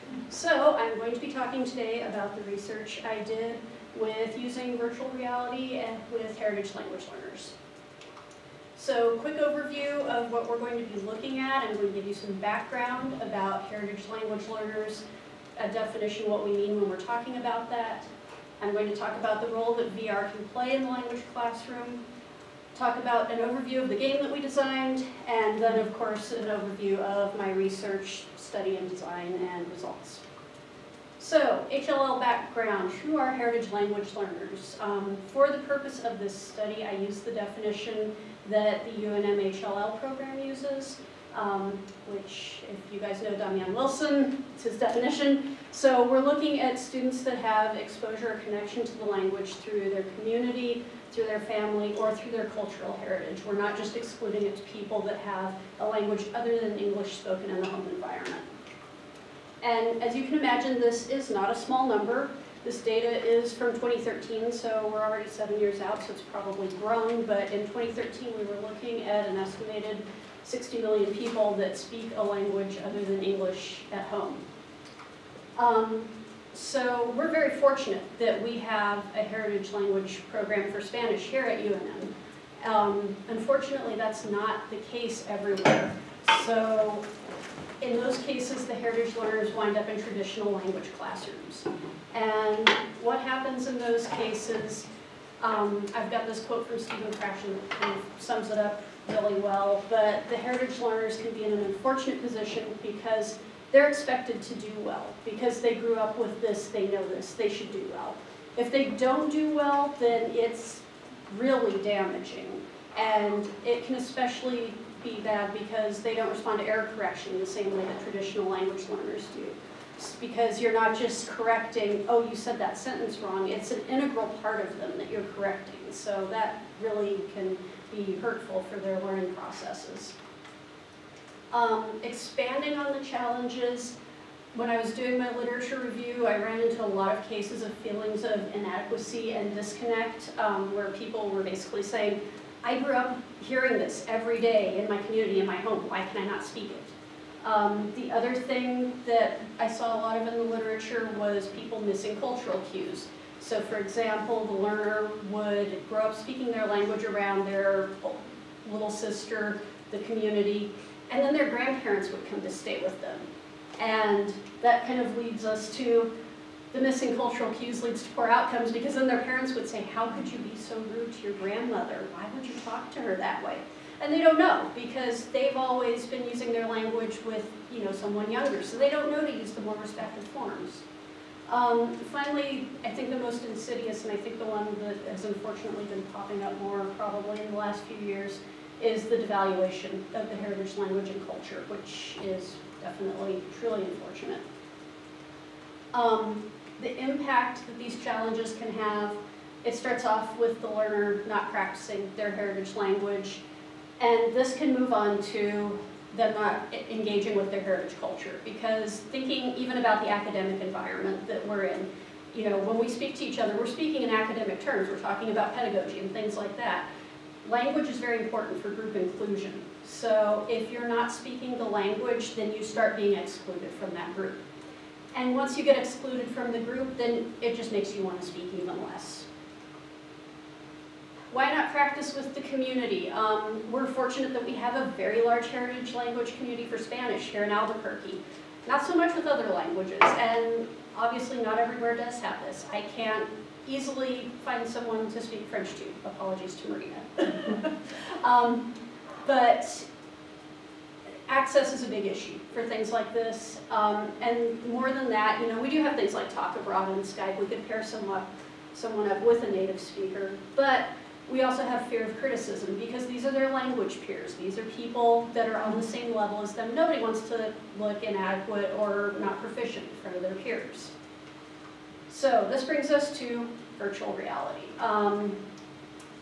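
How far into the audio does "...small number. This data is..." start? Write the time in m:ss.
1:01.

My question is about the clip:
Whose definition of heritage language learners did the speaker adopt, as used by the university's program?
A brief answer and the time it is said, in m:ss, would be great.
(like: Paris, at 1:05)
Damian Wilson, at 0:43.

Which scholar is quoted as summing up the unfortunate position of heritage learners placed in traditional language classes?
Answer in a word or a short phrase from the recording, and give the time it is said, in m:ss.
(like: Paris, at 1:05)
Stephen Krashen, at 1:36.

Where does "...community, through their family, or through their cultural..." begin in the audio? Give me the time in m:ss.
0:50.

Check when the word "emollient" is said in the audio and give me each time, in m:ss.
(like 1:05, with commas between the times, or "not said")
not said.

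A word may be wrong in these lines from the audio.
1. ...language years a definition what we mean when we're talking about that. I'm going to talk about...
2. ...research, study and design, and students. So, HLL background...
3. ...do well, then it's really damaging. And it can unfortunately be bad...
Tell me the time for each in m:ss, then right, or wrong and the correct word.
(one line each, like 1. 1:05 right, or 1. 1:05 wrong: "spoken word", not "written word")
1. 0:14 wrong: "learners", not "years"
2. 0:27 wrong: "results", not "students"
3. 1:49 wrong: "especially", not "unfortunately".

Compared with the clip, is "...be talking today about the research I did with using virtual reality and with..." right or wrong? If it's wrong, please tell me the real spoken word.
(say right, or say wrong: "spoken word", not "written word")
right.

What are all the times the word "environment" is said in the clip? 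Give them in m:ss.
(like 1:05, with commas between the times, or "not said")
0:57, 3:30.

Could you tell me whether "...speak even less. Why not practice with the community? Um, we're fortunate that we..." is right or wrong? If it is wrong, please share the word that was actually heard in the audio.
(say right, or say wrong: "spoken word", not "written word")
right.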